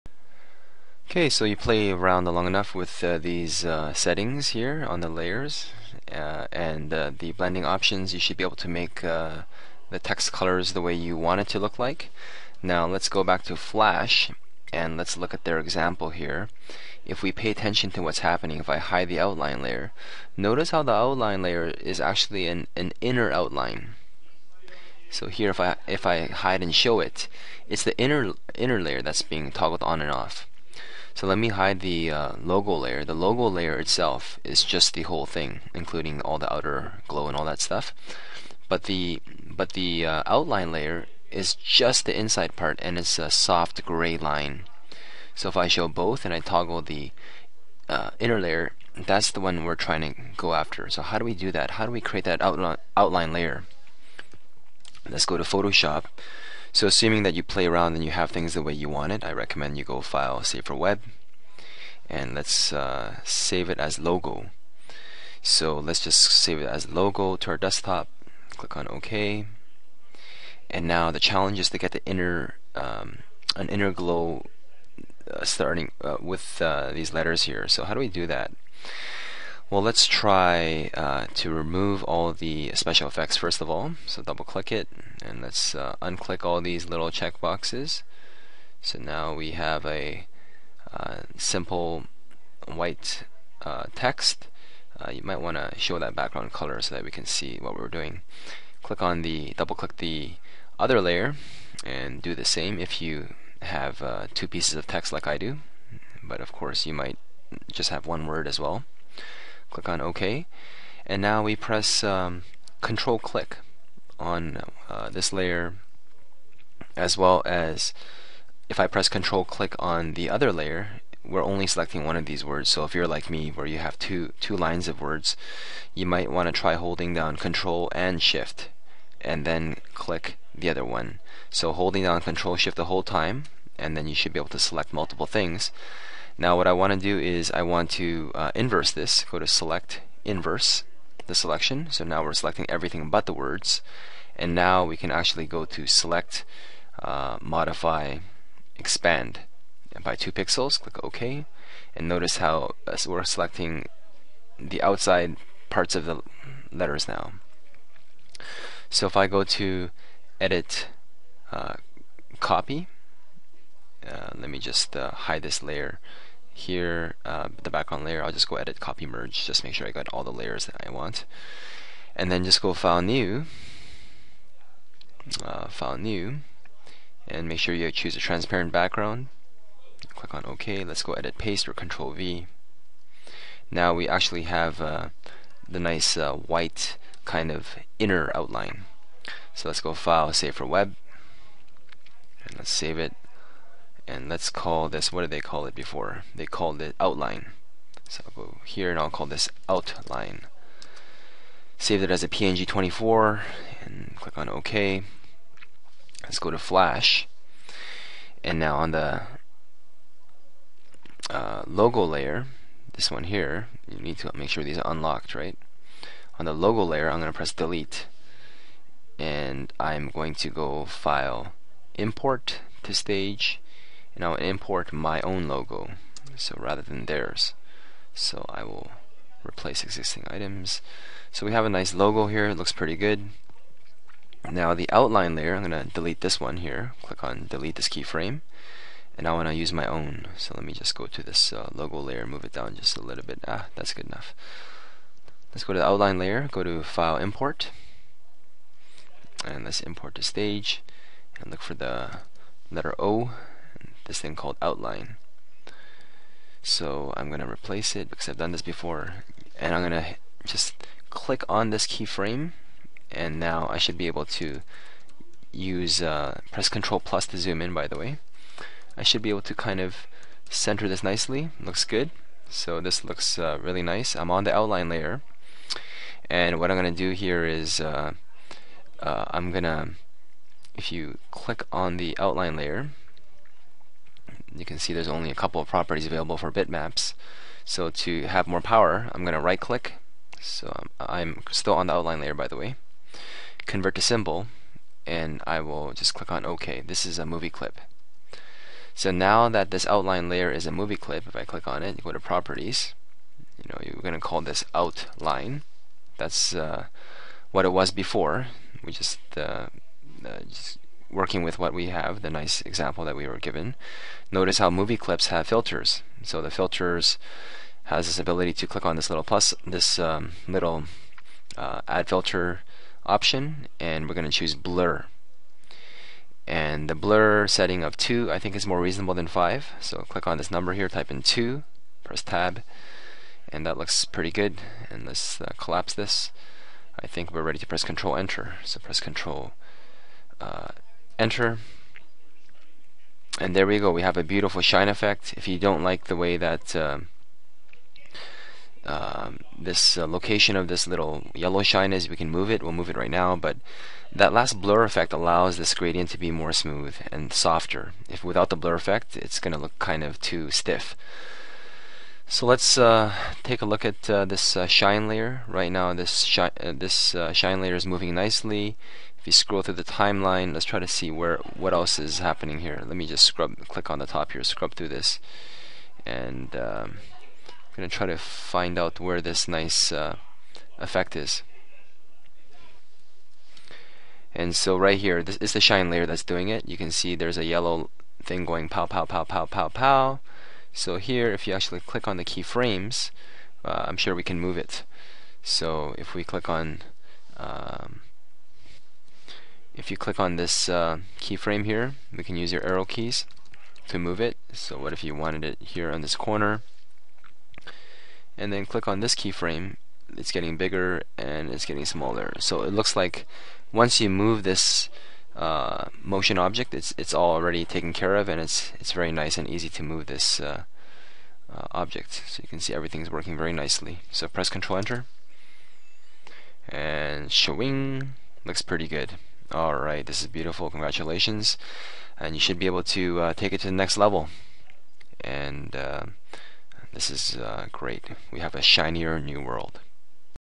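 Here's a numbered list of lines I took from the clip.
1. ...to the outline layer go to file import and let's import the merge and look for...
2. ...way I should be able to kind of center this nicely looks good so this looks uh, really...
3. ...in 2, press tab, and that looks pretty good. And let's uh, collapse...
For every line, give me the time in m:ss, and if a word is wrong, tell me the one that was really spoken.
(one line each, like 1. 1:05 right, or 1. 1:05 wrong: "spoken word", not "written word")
1. 4:05 wrong: "stage", not "merge"
2. 4:27 right
3. 5:31 right.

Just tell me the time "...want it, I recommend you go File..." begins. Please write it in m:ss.
0:58.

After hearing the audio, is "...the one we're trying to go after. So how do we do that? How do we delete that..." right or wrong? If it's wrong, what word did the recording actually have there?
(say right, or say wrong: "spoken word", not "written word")
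wrong: "create", not "delete".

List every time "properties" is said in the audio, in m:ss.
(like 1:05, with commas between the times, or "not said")
4:45, 5:02.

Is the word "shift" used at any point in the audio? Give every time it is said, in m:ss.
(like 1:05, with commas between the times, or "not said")
2:08, 2:12.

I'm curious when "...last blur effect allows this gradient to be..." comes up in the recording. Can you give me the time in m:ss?
5:54.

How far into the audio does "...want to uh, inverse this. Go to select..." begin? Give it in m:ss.
2:17.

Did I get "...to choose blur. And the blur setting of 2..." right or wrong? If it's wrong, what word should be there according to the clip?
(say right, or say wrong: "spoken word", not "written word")
right.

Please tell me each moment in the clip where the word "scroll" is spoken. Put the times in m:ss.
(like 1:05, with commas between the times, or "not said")
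6:09.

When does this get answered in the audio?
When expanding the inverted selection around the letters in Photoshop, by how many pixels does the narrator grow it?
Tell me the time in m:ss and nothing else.
2:30.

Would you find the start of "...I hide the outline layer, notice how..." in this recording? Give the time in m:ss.
0:18.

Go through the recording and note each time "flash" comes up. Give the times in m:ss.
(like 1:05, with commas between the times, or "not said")
0:13, 3:26.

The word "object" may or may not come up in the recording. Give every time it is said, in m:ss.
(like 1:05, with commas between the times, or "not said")
6:56, 7:01.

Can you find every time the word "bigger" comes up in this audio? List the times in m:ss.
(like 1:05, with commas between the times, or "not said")
6:50.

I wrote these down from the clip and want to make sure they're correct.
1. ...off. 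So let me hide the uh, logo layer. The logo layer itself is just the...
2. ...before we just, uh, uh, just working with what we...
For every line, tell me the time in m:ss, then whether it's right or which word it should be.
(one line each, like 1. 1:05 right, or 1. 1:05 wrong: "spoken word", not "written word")
1. 0:30 right
2. 5:07 right.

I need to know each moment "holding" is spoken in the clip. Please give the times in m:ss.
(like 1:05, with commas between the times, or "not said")
2:06, 2:11.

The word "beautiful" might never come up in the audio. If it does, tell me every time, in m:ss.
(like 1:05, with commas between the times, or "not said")
5:44, 7:10.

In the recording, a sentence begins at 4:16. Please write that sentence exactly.
So I'm going to replace it because I've done this before.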